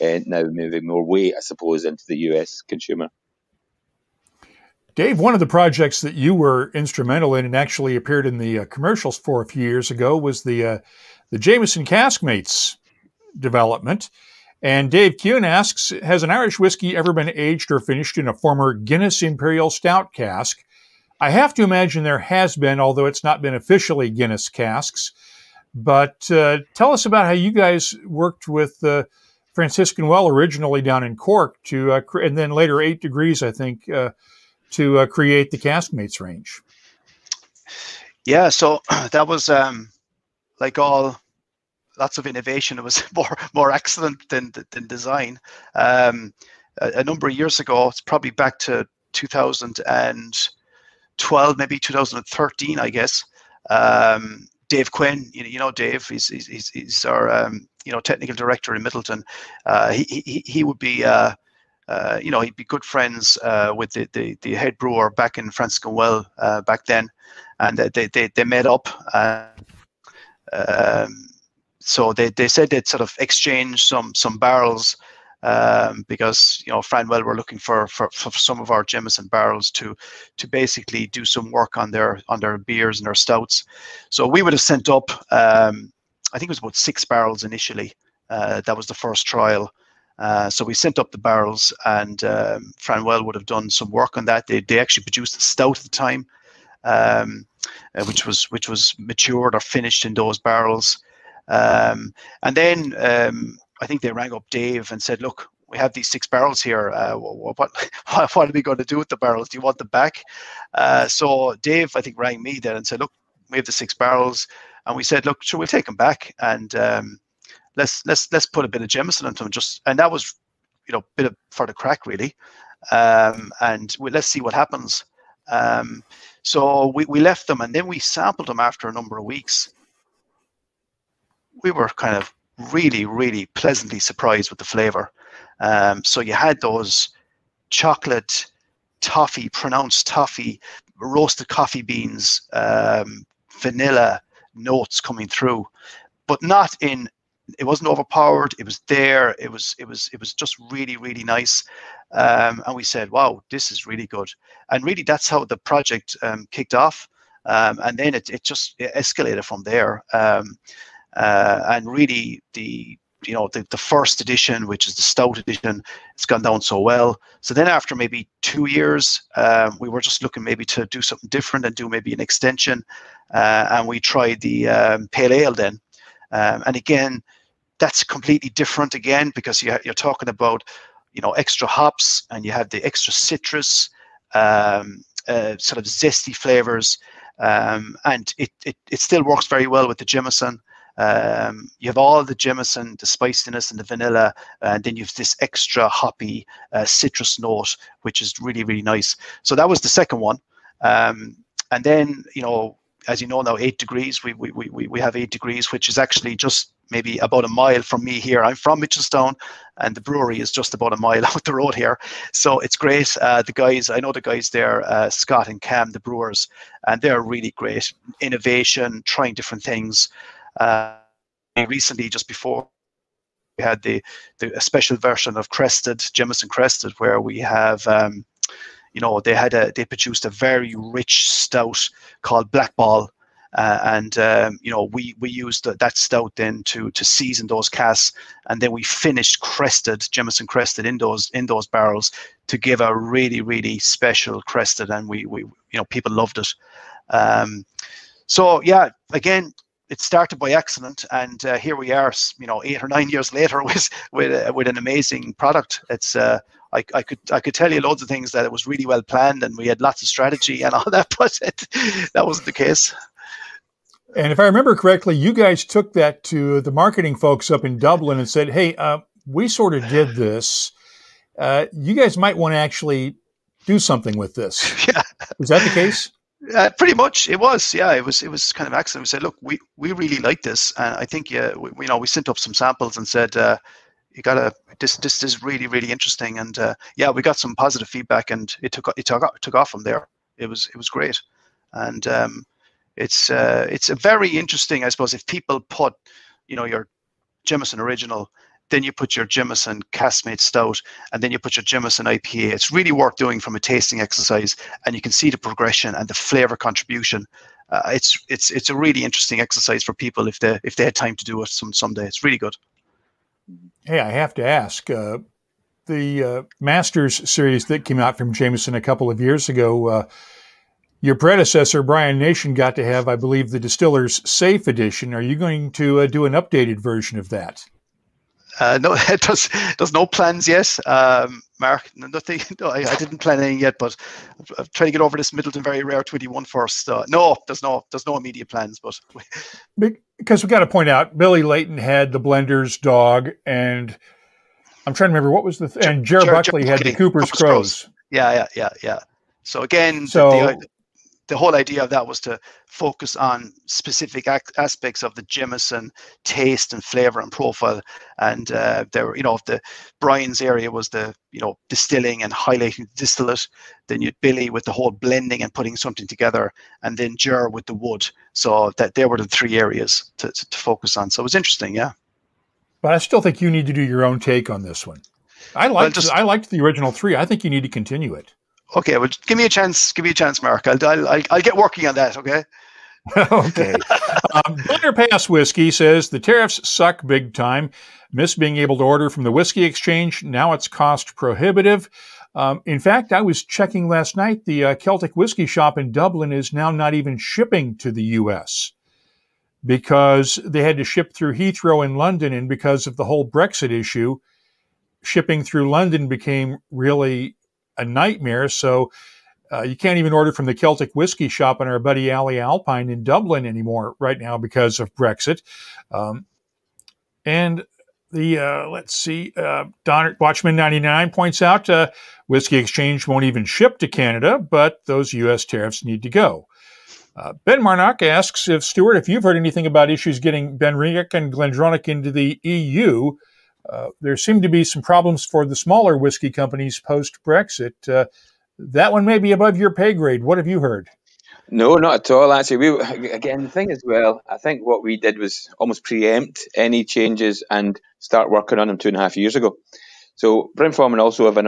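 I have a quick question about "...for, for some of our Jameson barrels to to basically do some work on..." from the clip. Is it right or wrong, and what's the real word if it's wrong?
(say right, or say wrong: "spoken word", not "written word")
right.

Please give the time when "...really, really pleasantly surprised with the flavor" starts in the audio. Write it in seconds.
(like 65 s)
132 s.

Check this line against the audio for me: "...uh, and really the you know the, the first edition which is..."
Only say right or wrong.
right.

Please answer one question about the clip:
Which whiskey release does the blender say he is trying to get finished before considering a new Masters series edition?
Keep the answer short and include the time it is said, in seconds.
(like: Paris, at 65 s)
Midleton Very Rare 21, at 335 s.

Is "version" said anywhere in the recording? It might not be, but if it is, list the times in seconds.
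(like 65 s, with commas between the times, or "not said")
224 s, 326 s.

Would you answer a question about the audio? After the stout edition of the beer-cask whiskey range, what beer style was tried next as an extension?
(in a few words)
Pale ale.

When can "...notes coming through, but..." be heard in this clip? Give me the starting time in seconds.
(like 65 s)
144 s.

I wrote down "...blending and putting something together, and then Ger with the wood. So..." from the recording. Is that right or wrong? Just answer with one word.
right.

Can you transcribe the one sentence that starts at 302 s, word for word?
It's really worth doing from a tasting exercise, and you can see the progression and the flavor contribution.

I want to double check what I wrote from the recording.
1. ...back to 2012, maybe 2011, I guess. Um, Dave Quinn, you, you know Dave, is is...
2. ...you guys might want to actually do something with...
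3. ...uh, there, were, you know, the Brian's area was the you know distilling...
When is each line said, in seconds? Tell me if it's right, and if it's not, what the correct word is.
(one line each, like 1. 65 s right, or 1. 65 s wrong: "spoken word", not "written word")
1. 48 s wrong: "2013", not "2011"
2. 271 s right
3. 358 s right.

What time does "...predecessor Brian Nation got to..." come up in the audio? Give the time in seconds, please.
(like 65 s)
321 s.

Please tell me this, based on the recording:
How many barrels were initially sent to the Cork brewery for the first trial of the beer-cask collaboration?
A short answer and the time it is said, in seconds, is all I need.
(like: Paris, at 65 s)
6, at 86 s.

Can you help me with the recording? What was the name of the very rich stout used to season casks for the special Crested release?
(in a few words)
Black Ball.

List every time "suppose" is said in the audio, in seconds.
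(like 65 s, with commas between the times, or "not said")
1 s, 294 s.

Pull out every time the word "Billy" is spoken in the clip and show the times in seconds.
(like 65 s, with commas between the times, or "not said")
341 s, 364 s.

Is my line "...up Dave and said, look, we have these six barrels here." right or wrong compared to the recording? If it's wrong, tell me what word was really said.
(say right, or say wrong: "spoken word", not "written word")
right.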